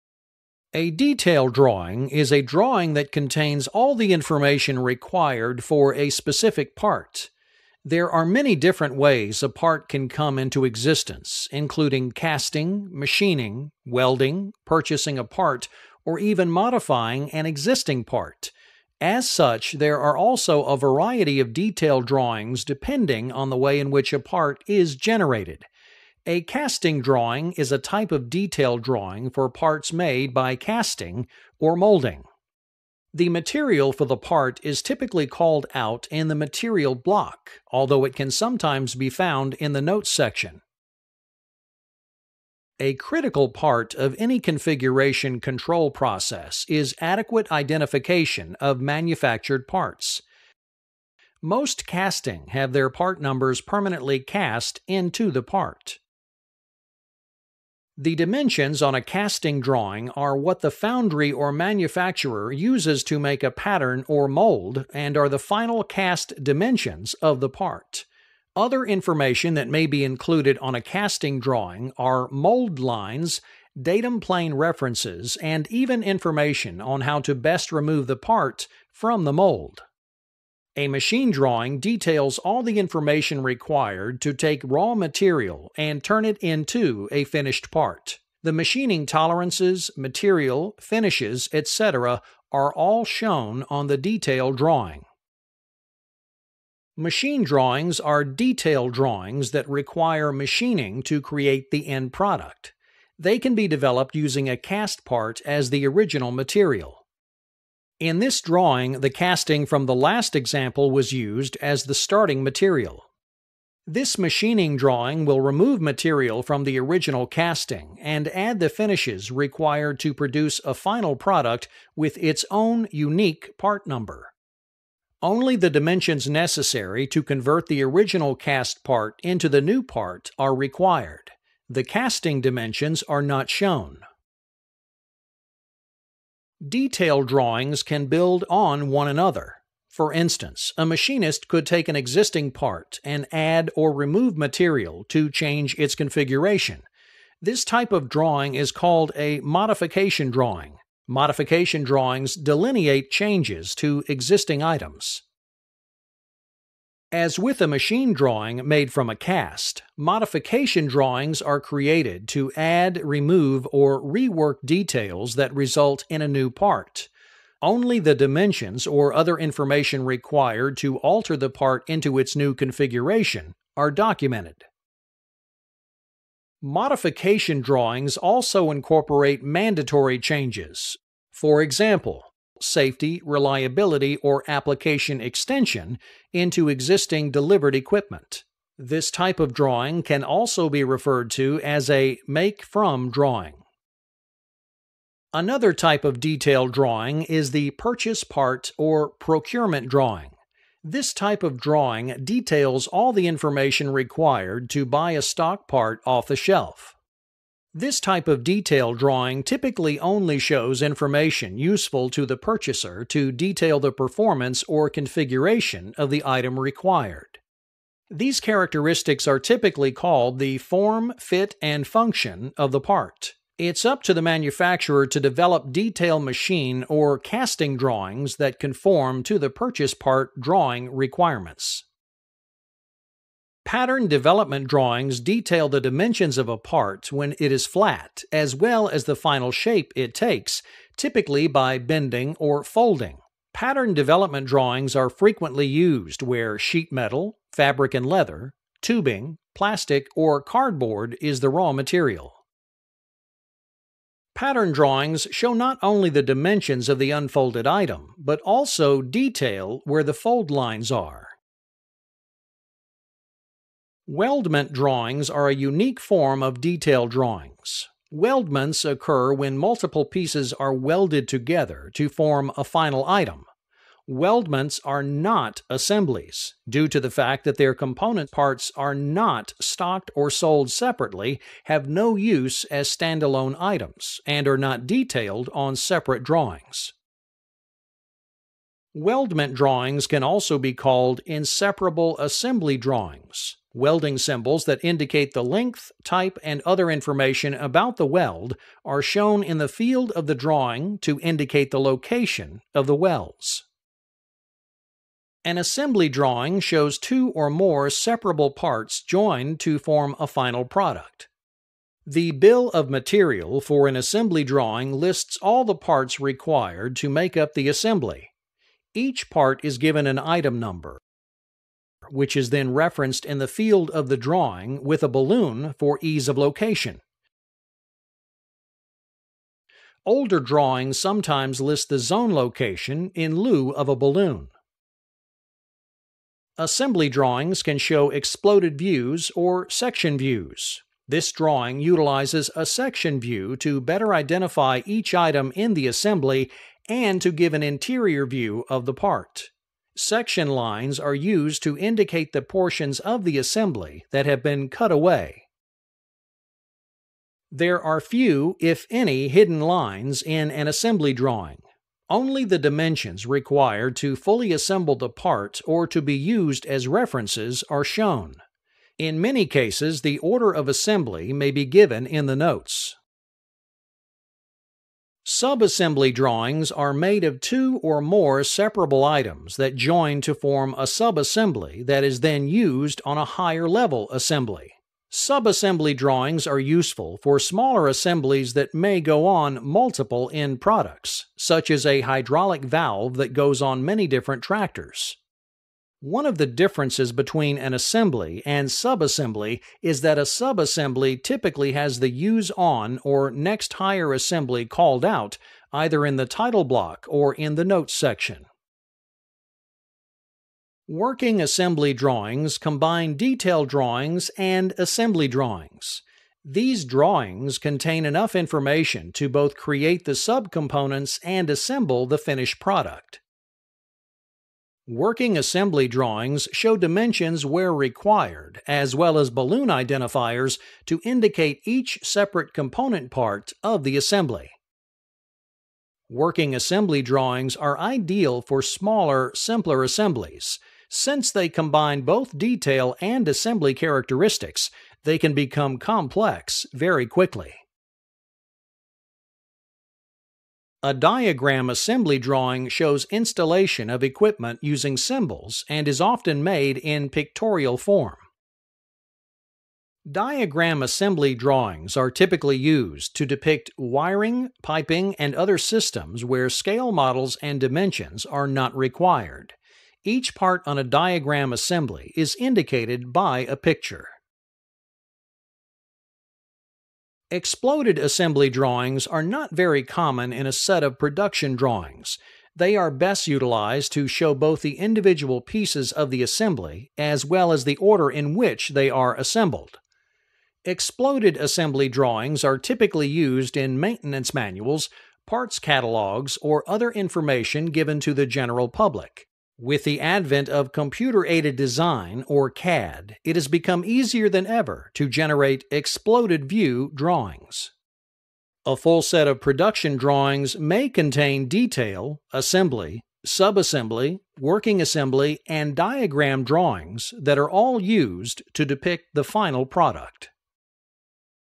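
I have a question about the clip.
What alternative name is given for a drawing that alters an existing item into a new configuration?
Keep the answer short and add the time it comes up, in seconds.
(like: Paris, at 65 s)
make from drawing, at 192 s.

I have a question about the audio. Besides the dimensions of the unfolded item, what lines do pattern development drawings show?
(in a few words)
fold lines.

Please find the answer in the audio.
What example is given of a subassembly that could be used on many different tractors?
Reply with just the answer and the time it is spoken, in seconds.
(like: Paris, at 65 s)
hydraulic valve, at 392 s.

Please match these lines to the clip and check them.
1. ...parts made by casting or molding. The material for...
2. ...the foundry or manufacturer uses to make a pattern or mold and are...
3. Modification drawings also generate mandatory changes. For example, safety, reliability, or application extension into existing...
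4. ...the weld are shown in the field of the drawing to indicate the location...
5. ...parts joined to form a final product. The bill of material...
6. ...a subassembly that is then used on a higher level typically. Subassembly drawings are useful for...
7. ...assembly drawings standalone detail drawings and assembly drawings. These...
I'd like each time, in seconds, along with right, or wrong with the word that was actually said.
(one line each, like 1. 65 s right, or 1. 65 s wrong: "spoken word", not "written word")
1. 29 s right
2. 60 s right
3. 176 s wrong: "incorporate", not "generate"
4. 297 s right
5. 308 s right
6. 380 s wrong: "assembly", not "typically"
7. 411 s wrong: "combine", not "standalone".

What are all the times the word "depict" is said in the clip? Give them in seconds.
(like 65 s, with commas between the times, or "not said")
463 s, 518 s.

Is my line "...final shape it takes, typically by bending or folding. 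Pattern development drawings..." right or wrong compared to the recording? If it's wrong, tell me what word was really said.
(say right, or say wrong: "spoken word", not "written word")
right.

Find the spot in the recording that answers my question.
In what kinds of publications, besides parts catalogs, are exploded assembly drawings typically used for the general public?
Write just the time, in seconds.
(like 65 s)
493 s.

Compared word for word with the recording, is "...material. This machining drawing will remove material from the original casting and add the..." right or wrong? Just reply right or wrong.
right.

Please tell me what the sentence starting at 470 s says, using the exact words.
Each part on a diagram assembly is indicated by a picture.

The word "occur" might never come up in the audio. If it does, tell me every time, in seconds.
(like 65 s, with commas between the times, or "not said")
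268 s.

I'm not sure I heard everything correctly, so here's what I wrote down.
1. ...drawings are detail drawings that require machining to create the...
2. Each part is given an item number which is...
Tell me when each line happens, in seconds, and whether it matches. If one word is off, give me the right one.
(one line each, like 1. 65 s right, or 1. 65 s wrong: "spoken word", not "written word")
1. 97 s right
2. 318 s right.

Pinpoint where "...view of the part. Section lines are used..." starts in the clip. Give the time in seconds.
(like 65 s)
348 s.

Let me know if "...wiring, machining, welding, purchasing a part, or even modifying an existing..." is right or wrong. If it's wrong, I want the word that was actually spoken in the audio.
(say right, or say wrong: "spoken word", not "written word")
wrong: "casting", not "wiring".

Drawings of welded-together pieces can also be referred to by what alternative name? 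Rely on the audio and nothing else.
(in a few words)
inseparable assembly drawings.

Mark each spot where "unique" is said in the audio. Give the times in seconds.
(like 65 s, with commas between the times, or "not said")
122 s, 265 s.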